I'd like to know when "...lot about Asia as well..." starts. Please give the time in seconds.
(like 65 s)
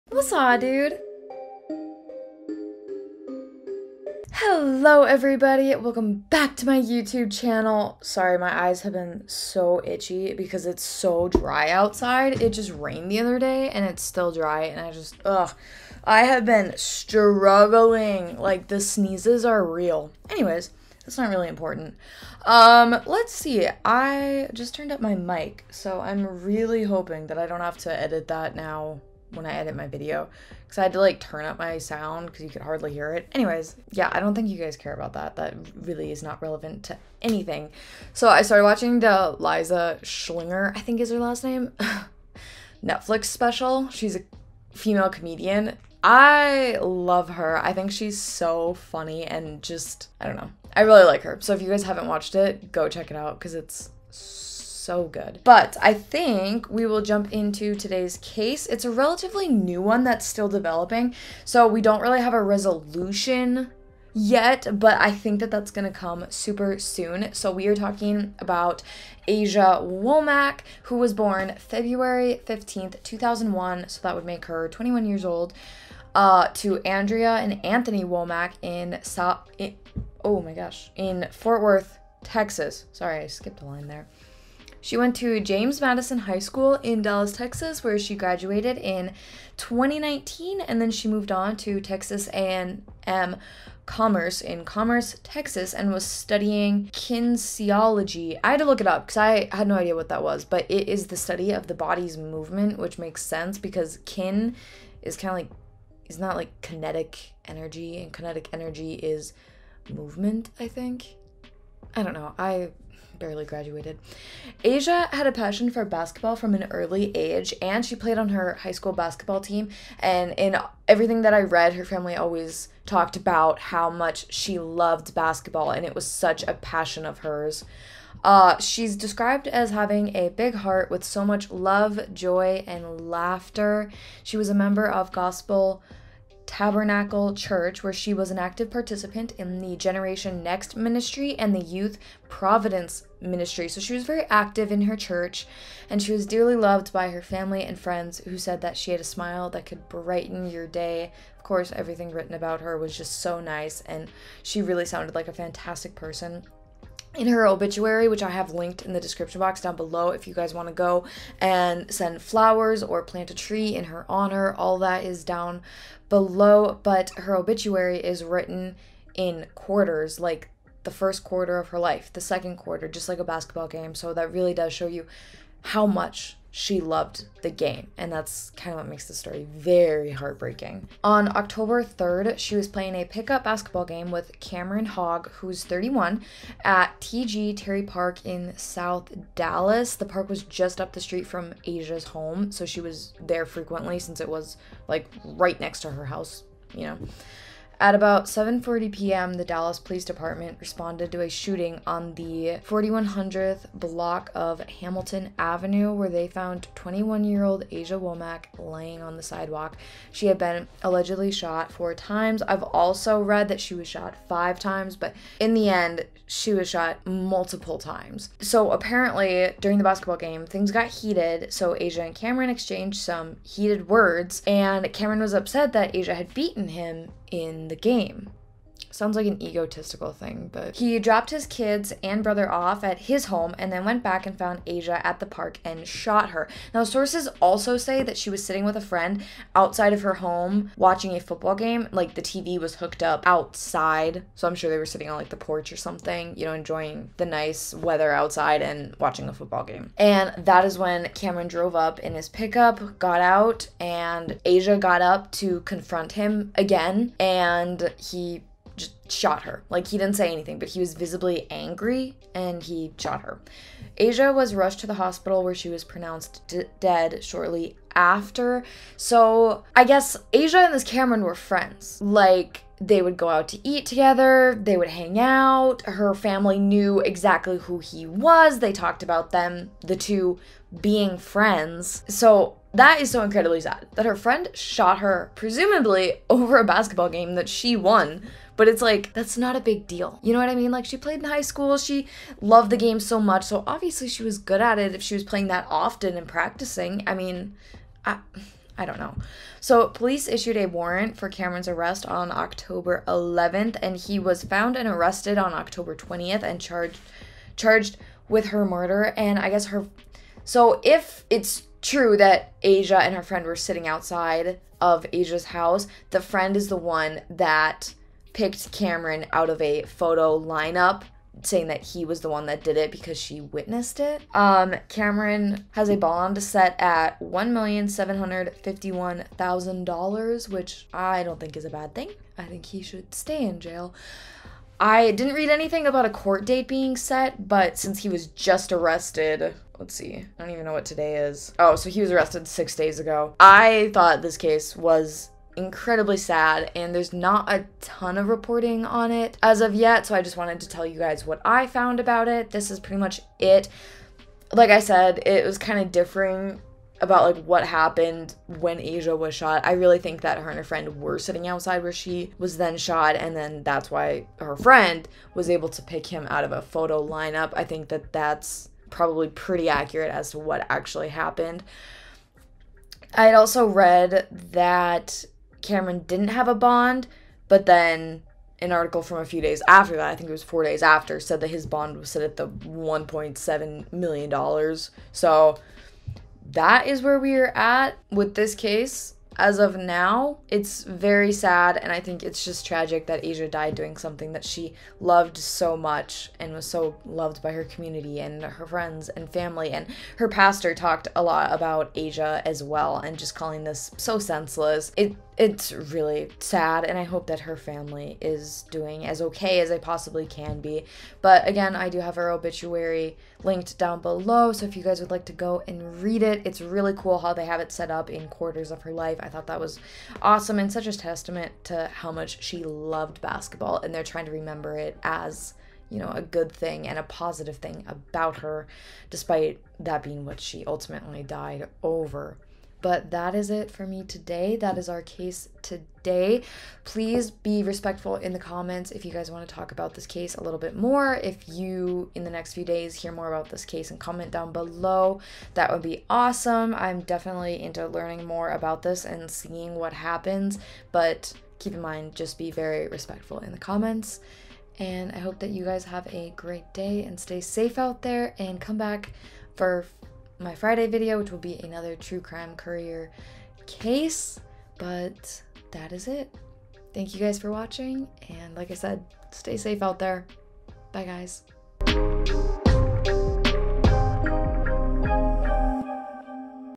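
401 s.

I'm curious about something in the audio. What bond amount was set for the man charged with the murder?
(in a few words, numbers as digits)
$1,751,000.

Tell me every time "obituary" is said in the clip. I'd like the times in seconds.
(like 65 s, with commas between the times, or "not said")
157 s, 167 s, 412 s.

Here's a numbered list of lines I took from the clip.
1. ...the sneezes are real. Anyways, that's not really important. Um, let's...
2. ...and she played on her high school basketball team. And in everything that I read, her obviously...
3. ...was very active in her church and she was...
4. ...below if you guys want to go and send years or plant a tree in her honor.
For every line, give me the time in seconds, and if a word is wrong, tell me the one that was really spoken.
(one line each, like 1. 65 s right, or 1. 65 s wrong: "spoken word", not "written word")
1. 18 s right
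2. 117 s wrong: "family", not "obviously"
3. 143 s right
4. 159 s wrong: "flowers", not "years".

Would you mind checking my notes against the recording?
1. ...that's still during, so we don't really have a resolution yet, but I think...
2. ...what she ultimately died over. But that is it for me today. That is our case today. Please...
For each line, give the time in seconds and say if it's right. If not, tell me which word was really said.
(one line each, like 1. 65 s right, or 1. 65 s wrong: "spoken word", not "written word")
1. 60 s wrong: "developing", not "during"
2. 430 s right.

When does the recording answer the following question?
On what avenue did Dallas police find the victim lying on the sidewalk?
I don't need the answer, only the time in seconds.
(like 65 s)
204 s.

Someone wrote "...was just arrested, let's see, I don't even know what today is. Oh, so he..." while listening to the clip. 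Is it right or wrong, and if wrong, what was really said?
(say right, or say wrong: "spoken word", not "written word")
right.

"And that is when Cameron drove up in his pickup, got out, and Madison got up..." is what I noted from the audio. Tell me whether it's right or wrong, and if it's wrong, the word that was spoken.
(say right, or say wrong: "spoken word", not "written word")
wrong: "Asia", not "Madison".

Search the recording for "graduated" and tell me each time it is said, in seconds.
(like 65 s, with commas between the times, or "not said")
88 s, 113 s.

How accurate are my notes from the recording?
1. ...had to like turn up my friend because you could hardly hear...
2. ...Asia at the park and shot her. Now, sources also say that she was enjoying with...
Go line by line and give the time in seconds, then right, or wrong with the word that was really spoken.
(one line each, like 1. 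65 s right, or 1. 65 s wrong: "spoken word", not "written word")
1. 30 s wrong: "sound", not "friend"
2. 234 s wrong: "sitting", not "enjoying".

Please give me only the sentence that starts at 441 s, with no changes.
If you, in the next few days, hear more about this case and comment down below, that would be awesome.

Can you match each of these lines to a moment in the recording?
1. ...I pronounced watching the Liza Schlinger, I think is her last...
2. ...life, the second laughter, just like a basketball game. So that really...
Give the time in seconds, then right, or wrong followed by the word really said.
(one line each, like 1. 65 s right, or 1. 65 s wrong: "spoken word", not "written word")
1. 38 s wrong: "started", not "pronounced"
2. 171 s wrong: "quarter", not "laughter".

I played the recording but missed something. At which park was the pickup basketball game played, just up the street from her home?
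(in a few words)
TG Terry Park.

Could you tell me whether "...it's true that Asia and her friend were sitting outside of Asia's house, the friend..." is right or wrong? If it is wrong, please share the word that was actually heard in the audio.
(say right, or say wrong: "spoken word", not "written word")
right.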